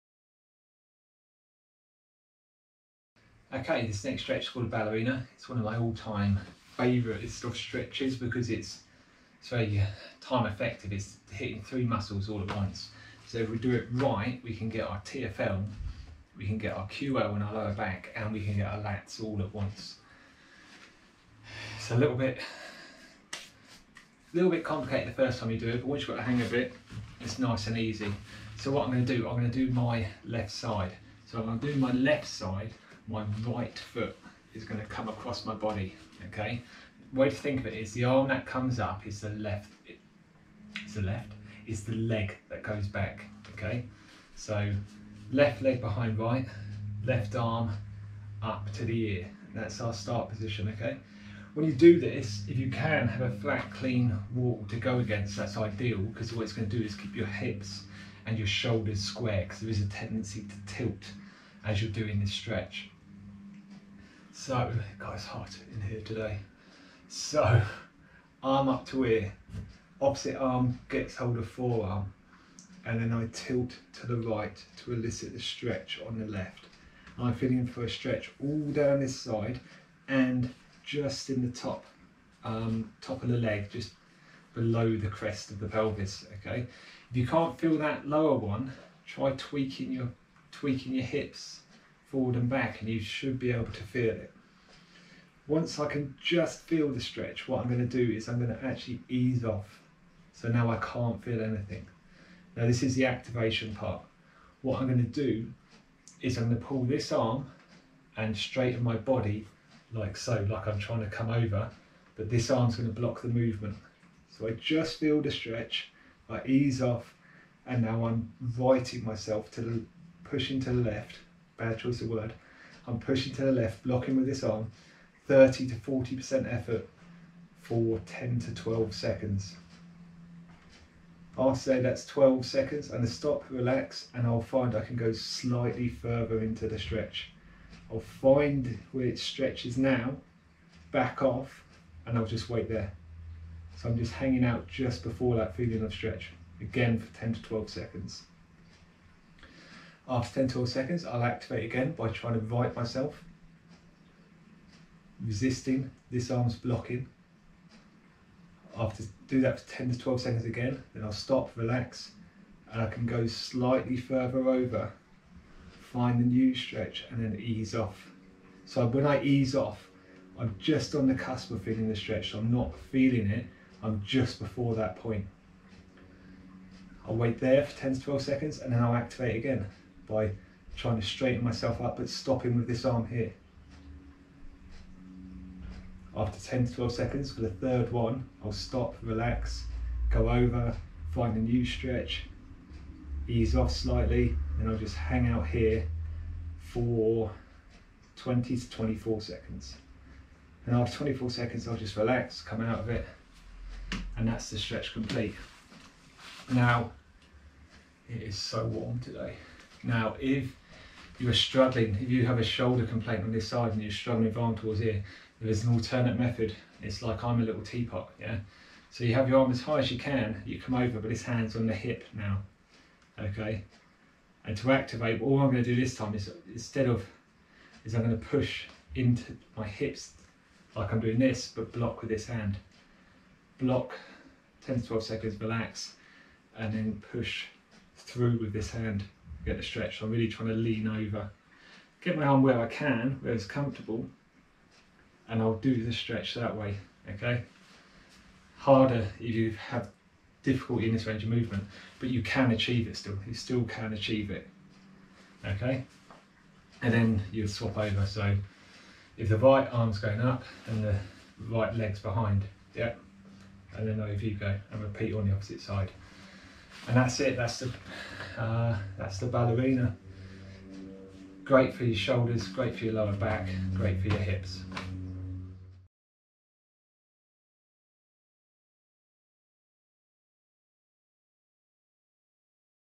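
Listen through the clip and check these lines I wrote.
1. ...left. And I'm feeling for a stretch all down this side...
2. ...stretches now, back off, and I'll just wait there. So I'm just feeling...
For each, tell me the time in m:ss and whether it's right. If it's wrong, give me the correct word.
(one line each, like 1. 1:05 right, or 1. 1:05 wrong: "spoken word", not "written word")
1. 1:16 right
2. 2:19 wrong: "hanging", not "feeling".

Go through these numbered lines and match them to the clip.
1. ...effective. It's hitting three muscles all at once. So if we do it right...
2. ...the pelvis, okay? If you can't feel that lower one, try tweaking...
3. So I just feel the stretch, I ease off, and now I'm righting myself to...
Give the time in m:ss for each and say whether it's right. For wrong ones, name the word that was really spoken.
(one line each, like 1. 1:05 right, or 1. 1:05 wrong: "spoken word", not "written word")
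1. 0:10 right
2. 1:25 right
3. 1:54 right.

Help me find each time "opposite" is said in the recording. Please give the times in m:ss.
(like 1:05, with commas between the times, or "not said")
1:10, 4:25.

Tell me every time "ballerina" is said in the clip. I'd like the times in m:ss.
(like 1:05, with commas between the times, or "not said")
0:04, 4:29.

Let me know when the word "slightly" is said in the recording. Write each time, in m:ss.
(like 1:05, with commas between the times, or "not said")
2:15, 2:43, 3:13.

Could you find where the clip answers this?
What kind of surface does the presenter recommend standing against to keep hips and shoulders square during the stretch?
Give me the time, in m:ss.
0:53.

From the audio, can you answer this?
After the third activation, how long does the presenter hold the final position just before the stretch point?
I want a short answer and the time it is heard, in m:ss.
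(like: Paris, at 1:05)
20 to 24 seconds, at 3:18.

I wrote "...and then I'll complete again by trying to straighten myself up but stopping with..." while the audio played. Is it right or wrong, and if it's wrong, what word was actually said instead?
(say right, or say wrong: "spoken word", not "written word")
wrong: "activate", not "complete".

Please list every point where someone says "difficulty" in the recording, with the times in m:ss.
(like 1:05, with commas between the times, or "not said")
4:10.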